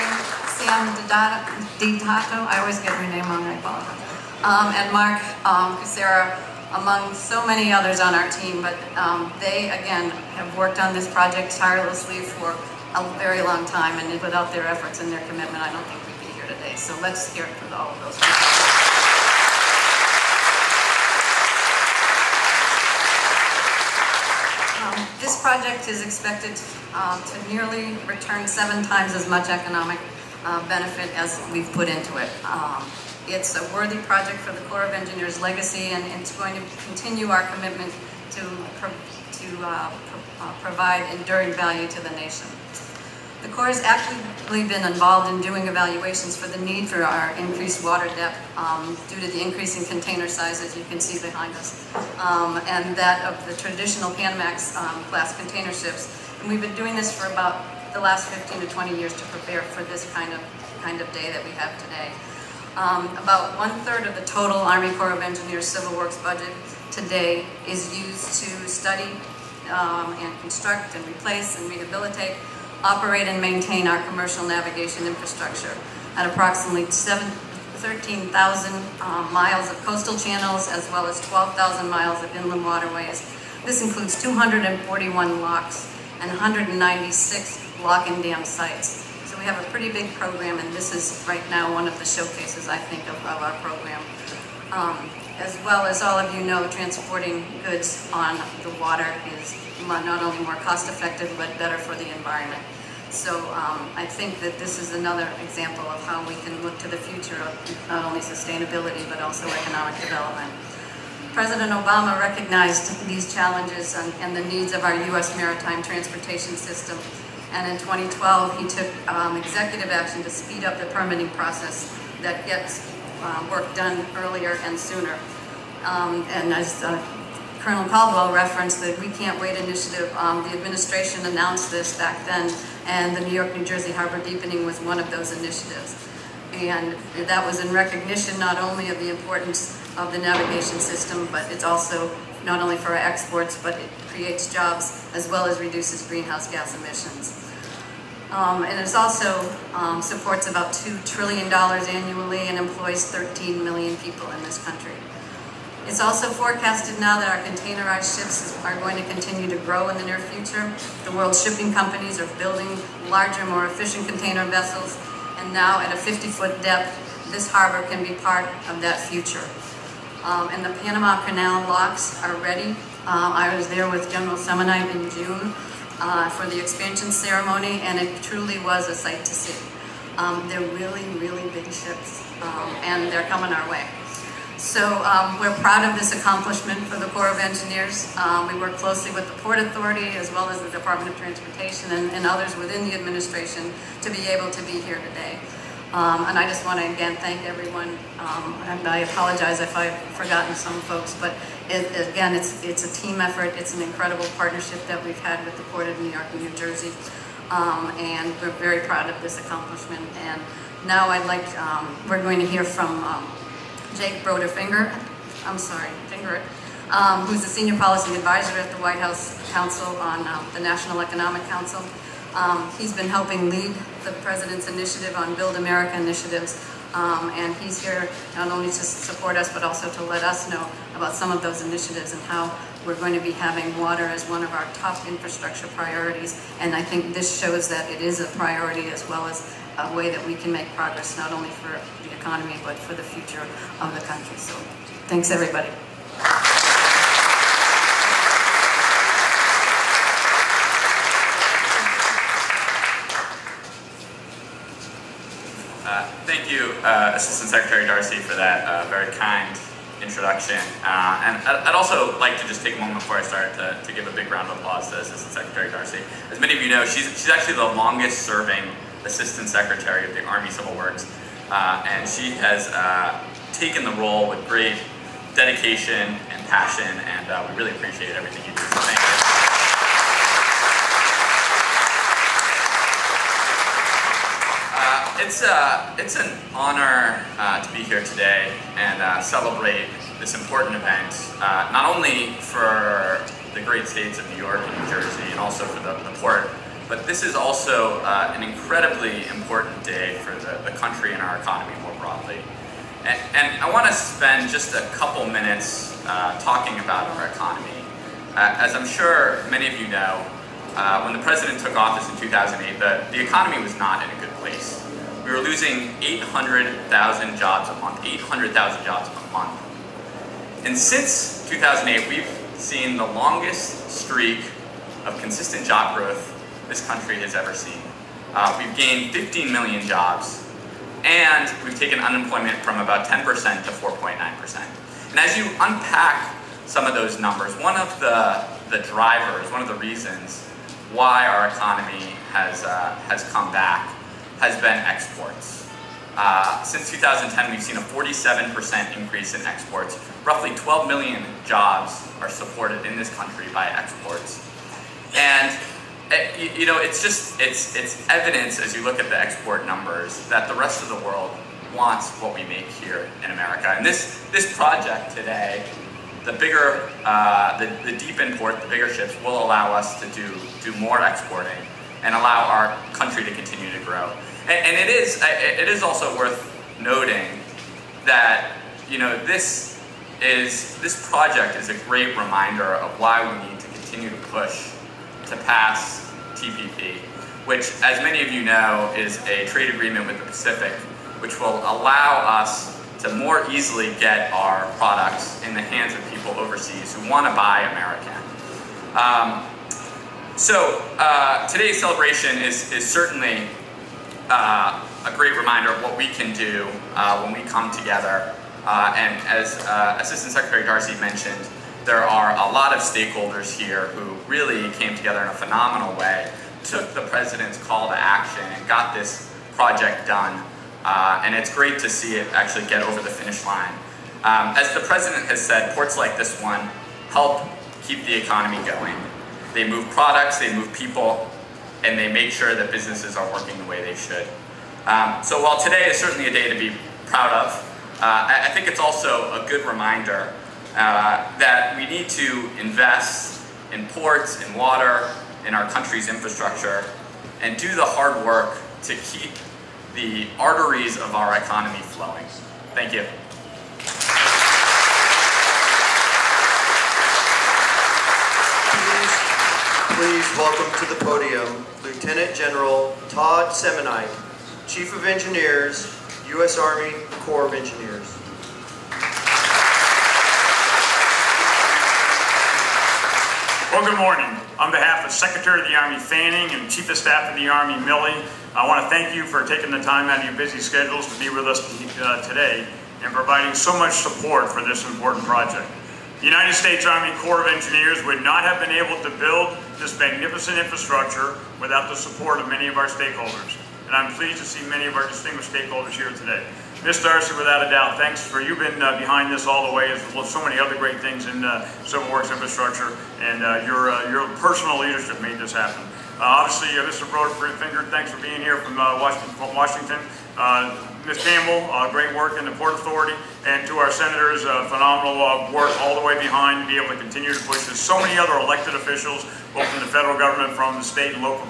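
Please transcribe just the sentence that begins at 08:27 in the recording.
Broder-Fingert, thanks for being here from Washington.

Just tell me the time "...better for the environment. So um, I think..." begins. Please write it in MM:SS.
01:41.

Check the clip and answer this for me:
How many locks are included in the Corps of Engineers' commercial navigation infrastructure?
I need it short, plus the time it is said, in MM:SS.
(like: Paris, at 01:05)
241, at 01:24.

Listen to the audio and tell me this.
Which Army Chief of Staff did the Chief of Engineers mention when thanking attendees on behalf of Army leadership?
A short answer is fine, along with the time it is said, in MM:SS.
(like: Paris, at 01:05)
Milley, at 07:57.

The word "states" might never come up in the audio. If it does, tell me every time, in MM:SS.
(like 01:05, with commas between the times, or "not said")
04:53, 08:06, 08:40.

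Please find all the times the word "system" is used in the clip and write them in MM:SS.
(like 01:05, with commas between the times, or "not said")
01:56, 02:20.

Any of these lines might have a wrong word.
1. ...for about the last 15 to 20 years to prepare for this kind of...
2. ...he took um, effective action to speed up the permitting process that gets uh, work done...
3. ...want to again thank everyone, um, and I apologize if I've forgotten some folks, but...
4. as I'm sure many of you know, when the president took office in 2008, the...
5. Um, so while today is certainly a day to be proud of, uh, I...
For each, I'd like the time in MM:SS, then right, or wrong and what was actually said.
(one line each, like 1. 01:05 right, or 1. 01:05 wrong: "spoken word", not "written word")
1. 00:57 right
2. 01:58 wrong: "executive", not "effective"
3. 03:16 right
4. 05:08 right
5. 07:14 right.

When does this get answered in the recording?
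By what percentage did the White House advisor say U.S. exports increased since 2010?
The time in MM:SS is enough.
05:47.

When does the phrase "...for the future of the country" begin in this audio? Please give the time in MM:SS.
04:02.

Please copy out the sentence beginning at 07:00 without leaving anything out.
Uh, and it's great to see it actually get over the finish line.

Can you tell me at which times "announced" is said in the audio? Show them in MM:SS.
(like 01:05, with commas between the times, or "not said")
02:11.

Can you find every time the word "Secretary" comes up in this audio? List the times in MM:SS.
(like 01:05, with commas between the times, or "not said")
04:17, 04:25, 04:29, 06:50, 07:55.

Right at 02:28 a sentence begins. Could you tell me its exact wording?
Um, and it also um, supports about $2 trillion annually and employs 13 million people in this country.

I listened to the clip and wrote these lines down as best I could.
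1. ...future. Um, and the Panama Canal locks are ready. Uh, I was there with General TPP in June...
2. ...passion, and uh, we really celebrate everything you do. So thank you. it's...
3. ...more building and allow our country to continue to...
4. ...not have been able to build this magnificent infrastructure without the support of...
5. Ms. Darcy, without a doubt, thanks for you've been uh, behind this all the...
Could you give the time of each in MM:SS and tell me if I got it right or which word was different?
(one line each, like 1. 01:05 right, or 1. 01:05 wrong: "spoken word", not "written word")
1. 02:48 wrong: "Semonite", not "TPP"
2. 04:36 wrong: "appreciate", not "celebrate"
3. 06:10 wrong: "exporting", not "building"
4. 08:08 right
5. 08:16 right.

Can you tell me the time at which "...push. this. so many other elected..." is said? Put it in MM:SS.
08:37.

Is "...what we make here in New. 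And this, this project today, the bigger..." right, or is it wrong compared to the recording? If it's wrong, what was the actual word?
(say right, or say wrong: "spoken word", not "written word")
wrong: "America", not "New".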